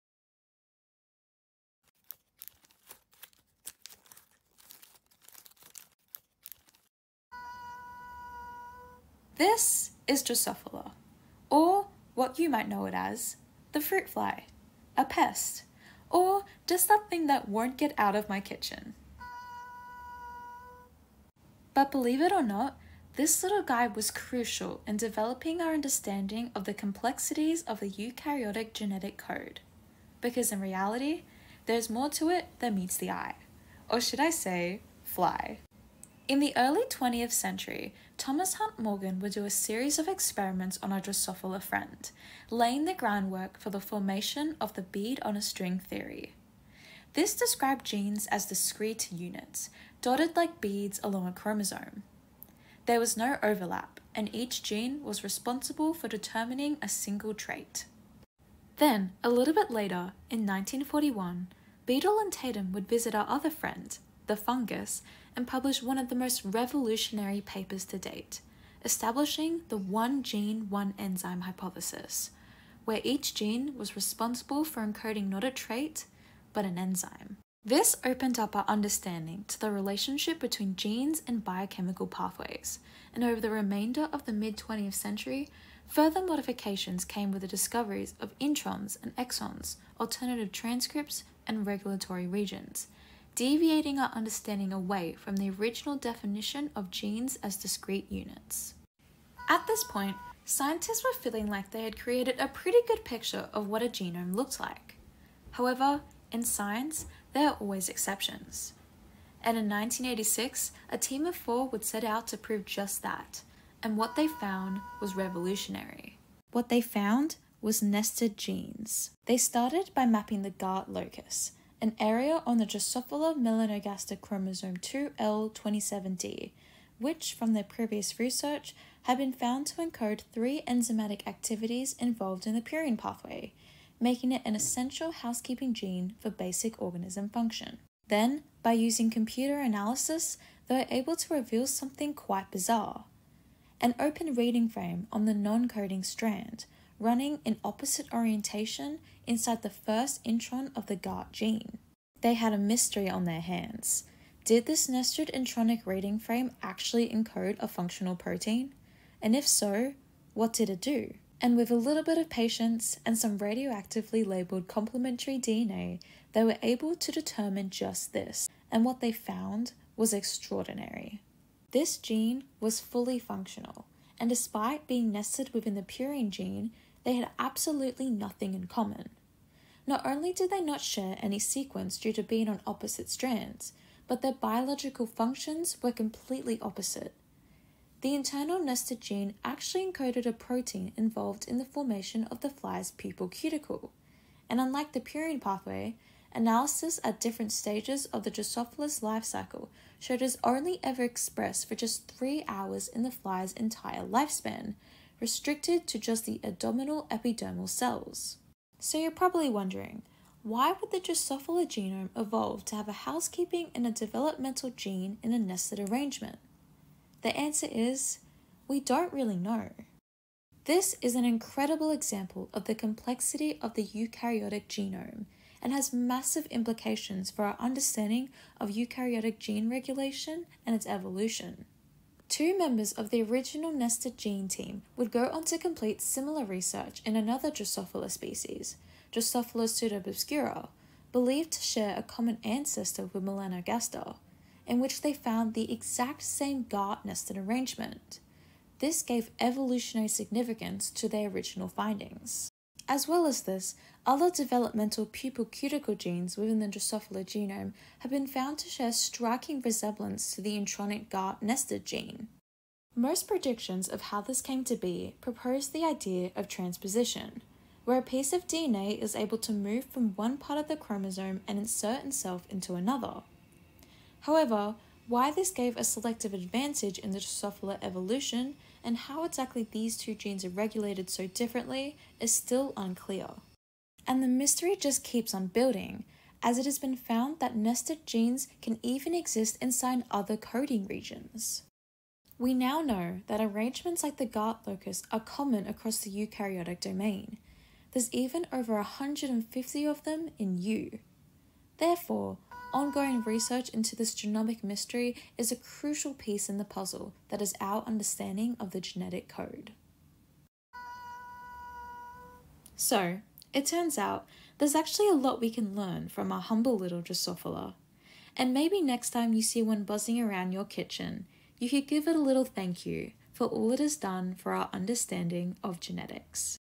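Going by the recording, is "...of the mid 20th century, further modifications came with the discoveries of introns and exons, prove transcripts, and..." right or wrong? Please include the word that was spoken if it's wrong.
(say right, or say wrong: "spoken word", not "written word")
wrong: "alternative", not "prove".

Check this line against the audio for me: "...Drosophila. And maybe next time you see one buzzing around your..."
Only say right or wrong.
right.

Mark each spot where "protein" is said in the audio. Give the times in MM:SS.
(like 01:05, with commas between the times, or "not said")
02:38, 03:10.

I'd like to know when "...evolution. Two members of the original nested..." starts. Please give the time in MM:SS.
03:50.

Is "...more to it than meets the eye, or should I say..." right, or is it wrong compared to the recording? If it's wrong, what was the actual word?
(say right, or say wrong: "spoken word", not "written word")
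right.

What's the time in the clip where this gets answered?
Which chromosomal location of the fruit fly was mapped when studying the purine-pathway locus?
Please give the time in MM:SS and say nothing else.
02:04.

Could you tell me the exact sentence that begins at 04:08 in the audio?
This gave evolutionary significance to their original findings.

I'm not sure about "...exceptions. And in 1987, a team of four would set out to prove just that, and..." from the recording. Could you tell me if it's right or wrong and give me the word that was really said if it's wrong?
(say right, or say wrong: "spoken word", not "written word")
wrong: "1986", not "1987".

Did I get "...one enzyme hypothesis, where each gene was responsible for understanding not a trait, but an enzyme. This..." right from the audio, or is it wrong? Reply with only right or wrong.
wrong.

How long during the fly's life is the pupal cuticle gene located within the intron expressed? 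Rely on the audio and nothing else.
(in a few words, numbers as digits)
3 hours.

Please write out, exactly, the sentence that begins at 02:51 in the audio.
This gene was fully functional, and despite being nested within the purine gene, they had absolutely nothing in common.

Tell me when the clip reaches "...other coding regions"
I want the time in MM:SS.
04:50.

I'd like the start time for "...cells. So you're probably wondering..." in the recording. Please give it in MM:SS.
03:27.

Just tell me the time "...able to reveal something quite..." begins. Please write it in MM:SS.
02:20.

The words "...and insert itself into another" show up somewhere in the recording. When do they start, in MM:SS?
04:31.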